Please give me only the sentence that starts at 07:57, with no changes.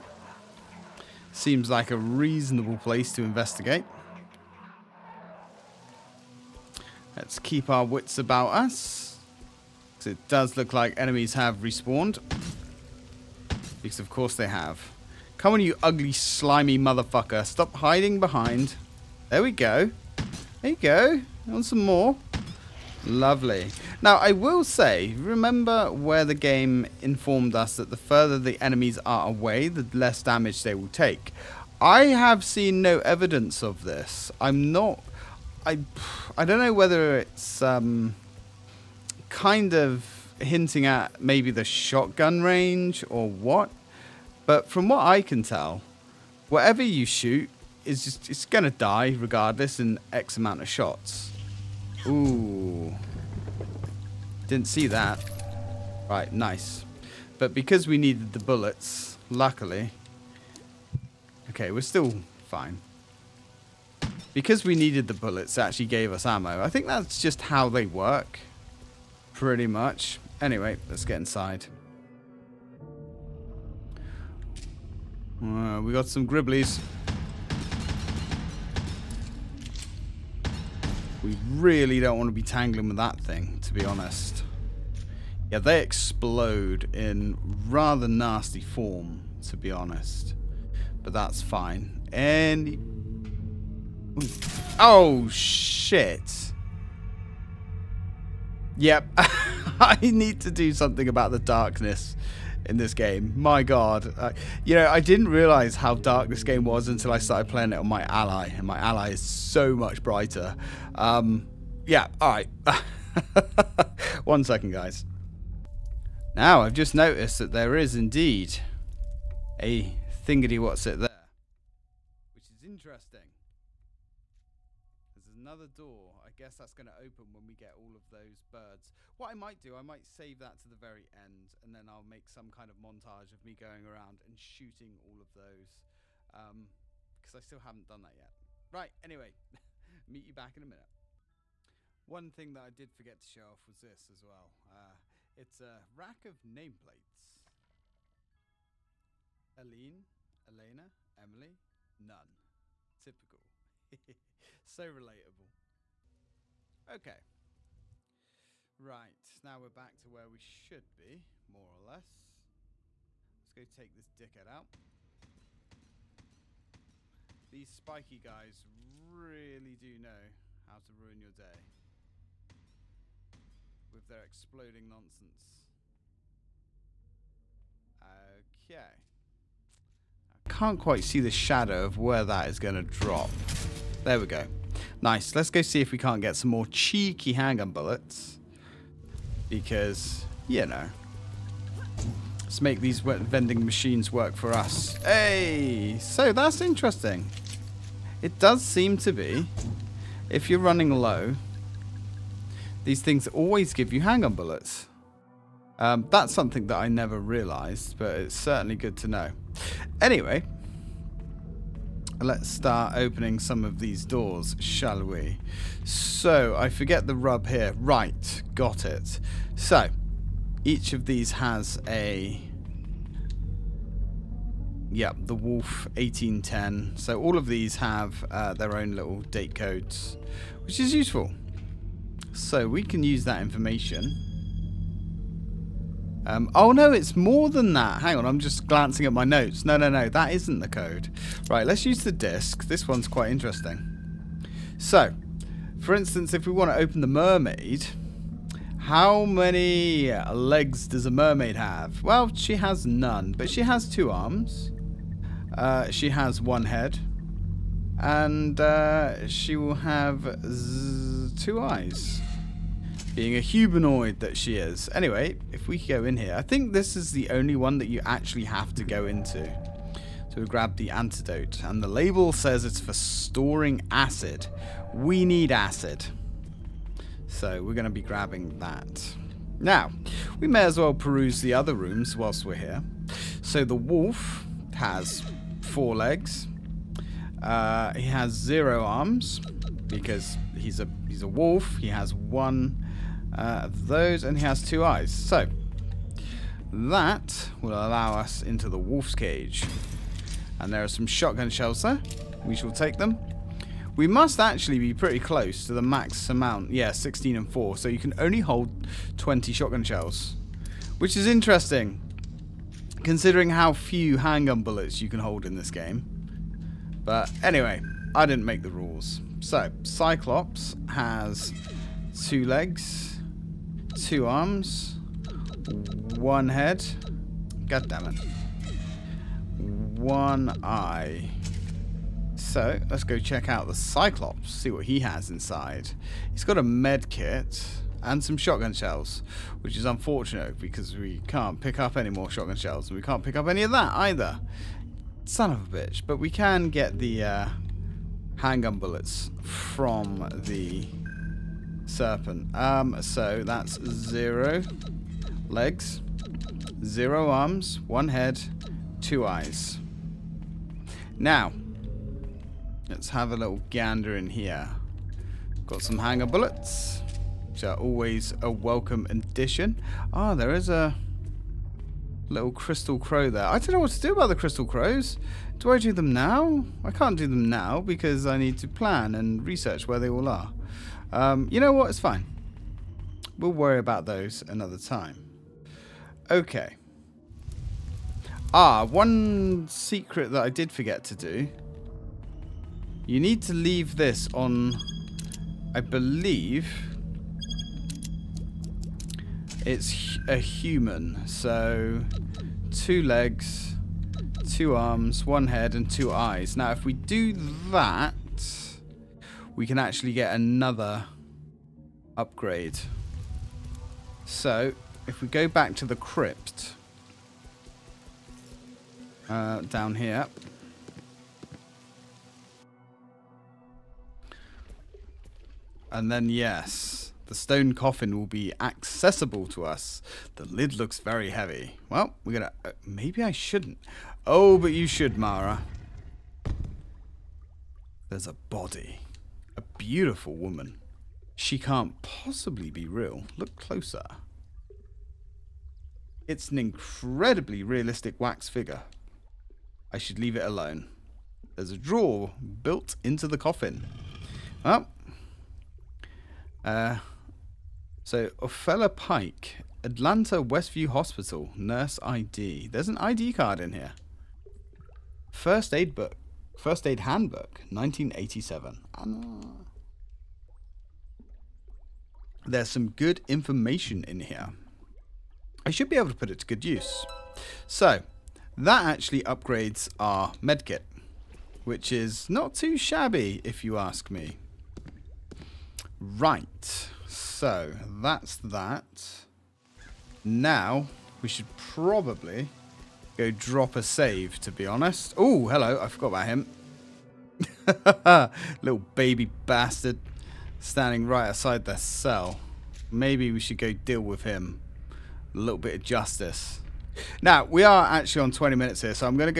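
So, that actually upgrades our medkit, which is not too shabby, if you ask me.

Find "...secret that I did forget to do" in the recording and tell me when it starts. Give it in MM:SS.
06:29.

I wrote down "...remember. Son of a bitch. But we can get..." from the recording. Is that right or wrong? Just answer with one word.
wrong.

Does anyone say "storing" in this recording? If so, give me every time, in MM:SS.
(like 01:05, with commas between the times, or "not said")
04:32.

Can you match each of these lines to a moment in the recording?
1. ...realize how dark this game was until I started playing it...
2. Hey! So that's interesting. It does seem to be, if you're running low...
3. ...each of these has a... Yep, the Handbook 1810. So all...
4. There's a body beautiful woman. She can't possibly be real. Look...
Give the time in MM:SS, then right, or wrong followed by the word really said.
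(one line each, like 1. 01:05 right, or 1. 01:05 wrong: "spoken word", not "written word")
1. 01:45 right
2. 03:15 right
3. 03:40 wrong: "Wolf", not "Handbook"
4. 07:18 right.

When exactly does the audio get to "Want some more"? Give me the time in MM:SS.
00:21.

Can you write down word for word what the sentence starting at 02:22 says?
One thing that I did forget to show off was this as well.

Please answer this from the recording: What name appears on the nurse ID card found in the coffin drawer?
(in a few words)
Ophelia Pike.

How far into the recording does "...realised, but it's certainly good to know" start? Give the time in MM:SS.
03:27.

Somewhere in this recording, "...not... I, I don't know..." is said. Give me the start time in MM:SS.
00:34.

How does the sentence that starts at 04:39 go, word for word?
Now, we may as well peruse the other rooms whilst we're here.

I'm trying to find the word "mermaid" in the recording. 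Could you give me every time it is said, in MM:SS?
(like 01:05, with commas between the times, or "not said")
04:07, 04:11.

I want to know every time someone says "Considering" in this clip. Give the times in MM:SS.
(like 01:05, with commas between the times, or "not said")
05:13.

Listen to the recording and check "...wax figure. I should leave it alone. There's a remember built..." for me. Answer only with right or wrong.
wrong.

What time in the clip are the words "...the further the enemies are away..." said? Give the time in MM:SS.
00:27.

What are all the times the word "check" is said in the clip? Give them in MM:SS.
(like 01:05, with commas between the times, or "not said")
05:33.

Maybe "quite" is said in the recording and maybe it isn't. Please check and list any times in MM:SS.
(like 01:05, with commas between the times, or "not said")
03:00, 04:03.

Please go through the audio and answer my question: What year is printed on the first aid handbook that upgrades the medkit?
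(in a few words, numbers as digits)
1987.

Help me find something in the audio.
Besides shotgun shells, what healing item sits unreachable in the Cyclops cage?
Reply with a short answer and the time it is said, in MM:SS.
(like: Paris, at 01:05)
Med kit, at 05:36.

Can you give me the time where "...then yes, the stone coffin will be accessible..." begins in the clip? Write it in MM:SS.
07:06.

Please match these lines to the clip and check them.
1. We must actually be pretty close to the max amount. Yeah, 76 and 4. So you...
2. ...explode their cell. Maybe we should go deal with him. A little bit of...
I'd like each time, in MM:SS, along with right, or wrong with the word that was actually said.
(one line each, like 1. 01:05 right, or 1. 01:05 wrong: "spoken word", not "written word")
1. 05:03 wrong: "16", not "76"
2. 08:21 wrong: "outside", not "explode".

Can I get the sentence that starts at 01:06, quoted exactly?
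I think that's just how they work.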